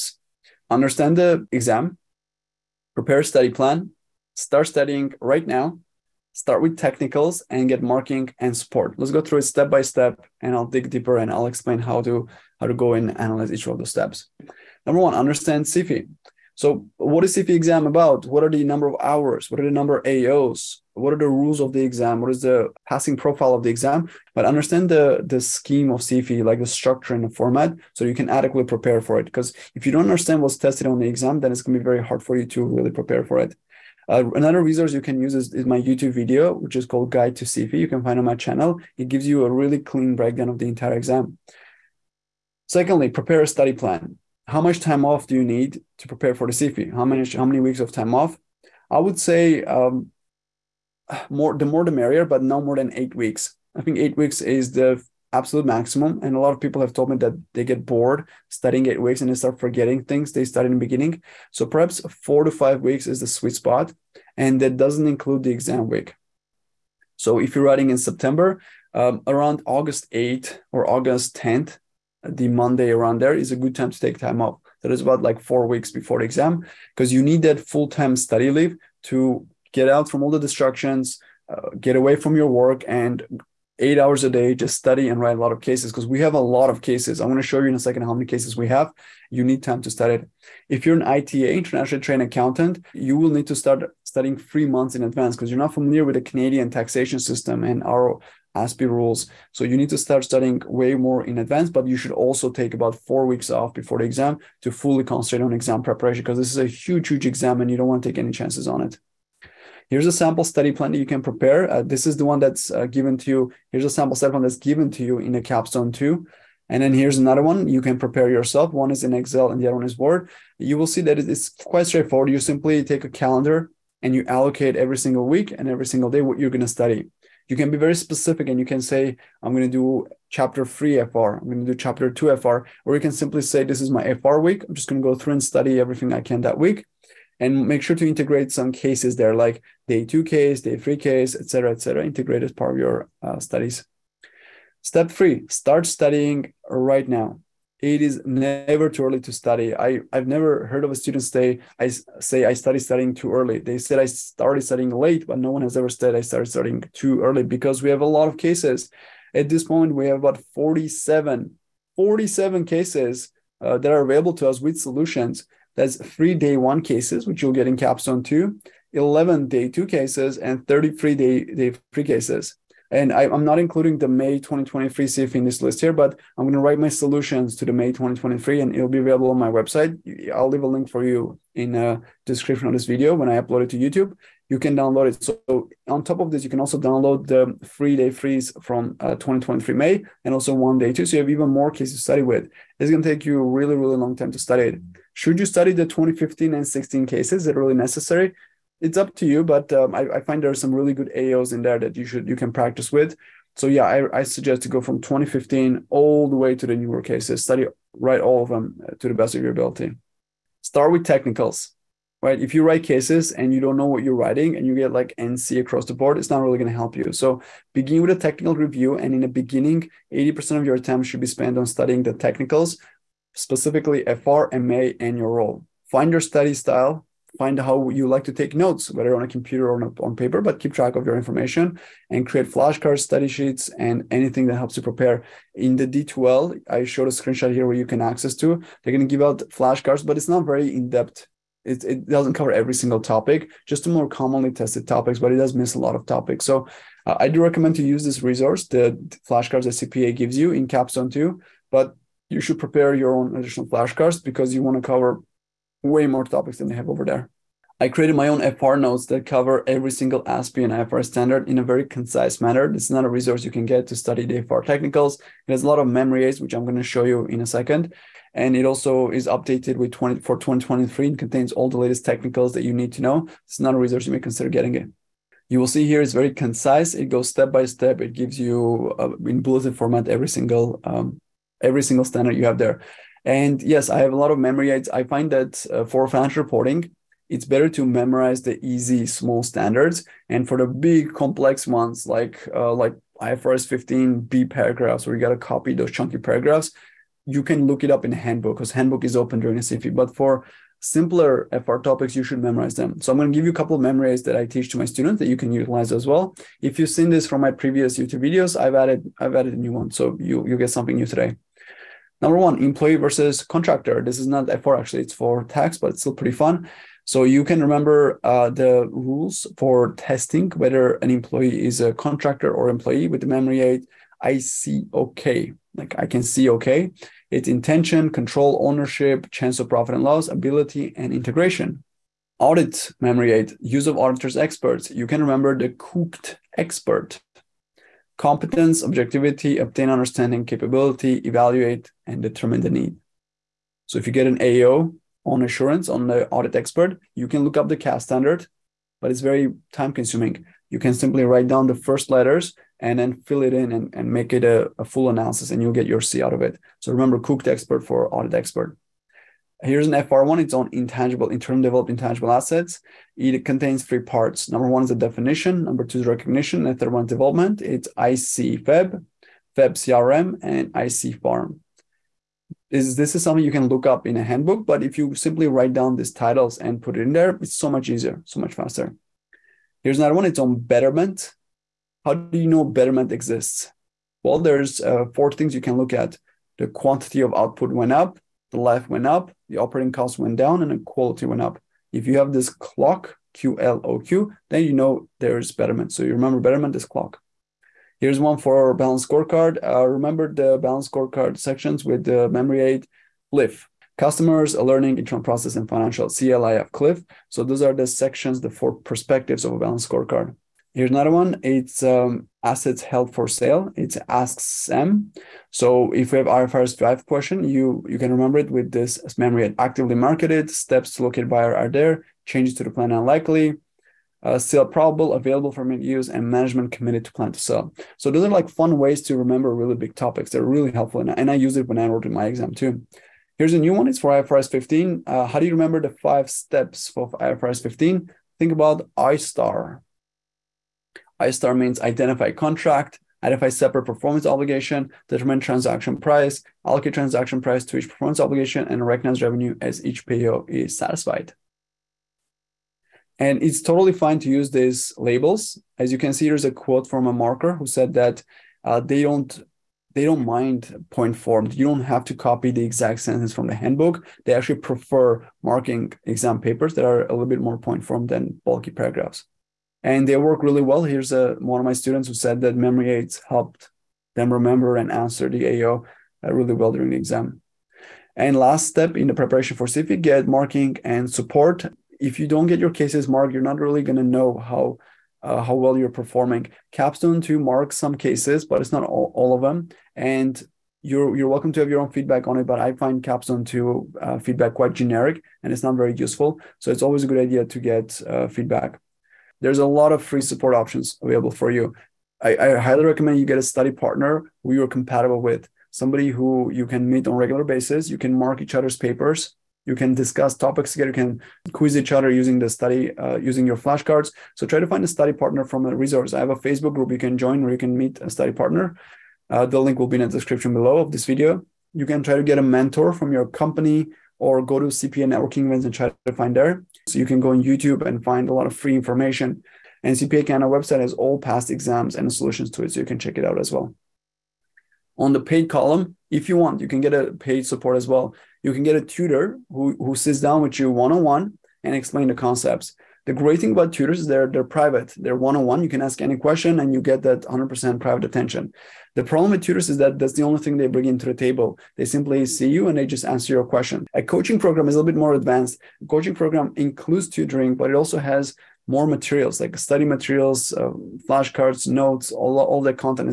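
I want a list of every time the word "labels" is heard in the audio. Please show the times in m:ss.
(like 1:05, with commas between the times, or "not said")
7:34.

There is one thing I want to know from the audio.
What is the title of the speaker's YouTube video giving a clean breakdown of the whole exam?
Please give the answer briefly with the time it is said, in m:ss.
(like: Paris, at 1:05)
Guide to CFE, at 0:37.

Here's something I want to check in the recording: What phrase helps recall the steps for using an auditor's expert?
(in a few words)
cook the expert.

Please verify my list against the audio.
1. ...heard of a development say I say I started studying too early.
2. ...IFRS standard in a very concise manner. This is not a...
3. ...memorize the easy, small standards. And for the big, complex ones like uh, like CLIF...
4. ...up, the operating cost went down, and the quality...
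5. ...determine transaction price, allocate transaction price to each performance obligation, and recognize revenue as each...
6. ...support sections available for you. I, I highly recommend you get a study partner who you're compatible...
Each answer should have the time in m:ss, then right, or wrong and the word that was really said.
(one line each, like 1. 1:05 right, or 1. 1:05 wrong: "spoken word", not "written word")
1. 2:30 wrong: "student", not "development"
2. 4:20 right
3. 4:47 wrong: "IFRS", not "CLIF"
4. 6:29 right
5. 7:25 right
6. 8:20 wrong: "options", not "sections".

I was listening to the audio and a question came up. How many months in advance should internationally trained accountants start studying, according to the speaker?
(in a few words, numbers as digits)
3.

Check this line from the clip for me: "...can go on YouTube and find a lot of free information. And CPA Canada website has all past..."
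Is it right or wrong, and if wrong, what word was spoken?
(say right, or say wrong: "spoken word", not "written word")
right.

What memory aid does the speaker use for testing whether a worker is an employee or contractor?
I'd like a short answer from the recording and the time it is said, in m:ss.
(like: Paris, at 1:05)
I see okay, at 5:24.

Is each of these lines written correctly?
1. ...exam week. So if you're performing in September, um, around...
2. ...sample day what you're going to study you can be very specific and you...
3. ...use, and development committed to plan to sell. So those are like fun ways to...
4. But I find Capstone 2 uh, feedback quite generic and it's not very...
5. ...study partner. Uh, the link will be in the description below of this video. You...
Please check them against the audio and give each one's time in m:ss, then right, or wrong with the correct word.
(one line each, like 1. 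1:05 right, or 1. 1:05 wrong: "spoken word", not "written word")
1. 1:05 wrong: "writing", not "performing"
2. 2:05 wrong: "single", not "sample"
3. 7:05 wrong: "management", not "development"
4. 8:12 right
5. 8:38 right.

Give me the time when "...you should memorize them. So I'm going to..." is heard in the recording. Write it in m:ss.
5:02.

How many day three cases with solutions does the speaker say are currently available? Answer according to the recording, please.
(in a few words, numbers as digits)
33.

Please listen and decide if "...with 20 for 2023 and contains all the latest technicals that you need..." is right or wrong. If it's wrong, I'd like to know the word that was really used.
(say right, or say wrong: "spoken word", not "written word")
right.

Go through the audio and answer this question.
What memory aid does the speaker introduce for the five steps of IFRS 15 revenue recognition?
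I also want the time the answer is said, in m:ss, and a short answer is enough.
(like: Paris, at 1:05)
ISTAR, at 7:21.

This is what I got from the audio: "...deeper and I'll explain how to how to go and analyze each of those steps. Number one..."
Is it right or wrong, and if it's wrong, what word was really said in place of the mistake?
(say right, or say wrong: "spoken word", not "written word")
right.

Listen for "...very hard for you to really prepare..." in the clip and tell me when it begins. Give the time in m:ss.
0:31.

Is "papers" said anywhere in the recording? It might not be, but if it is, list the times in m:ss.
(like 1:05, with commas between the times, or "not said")
3:50, 7:46, 8:28.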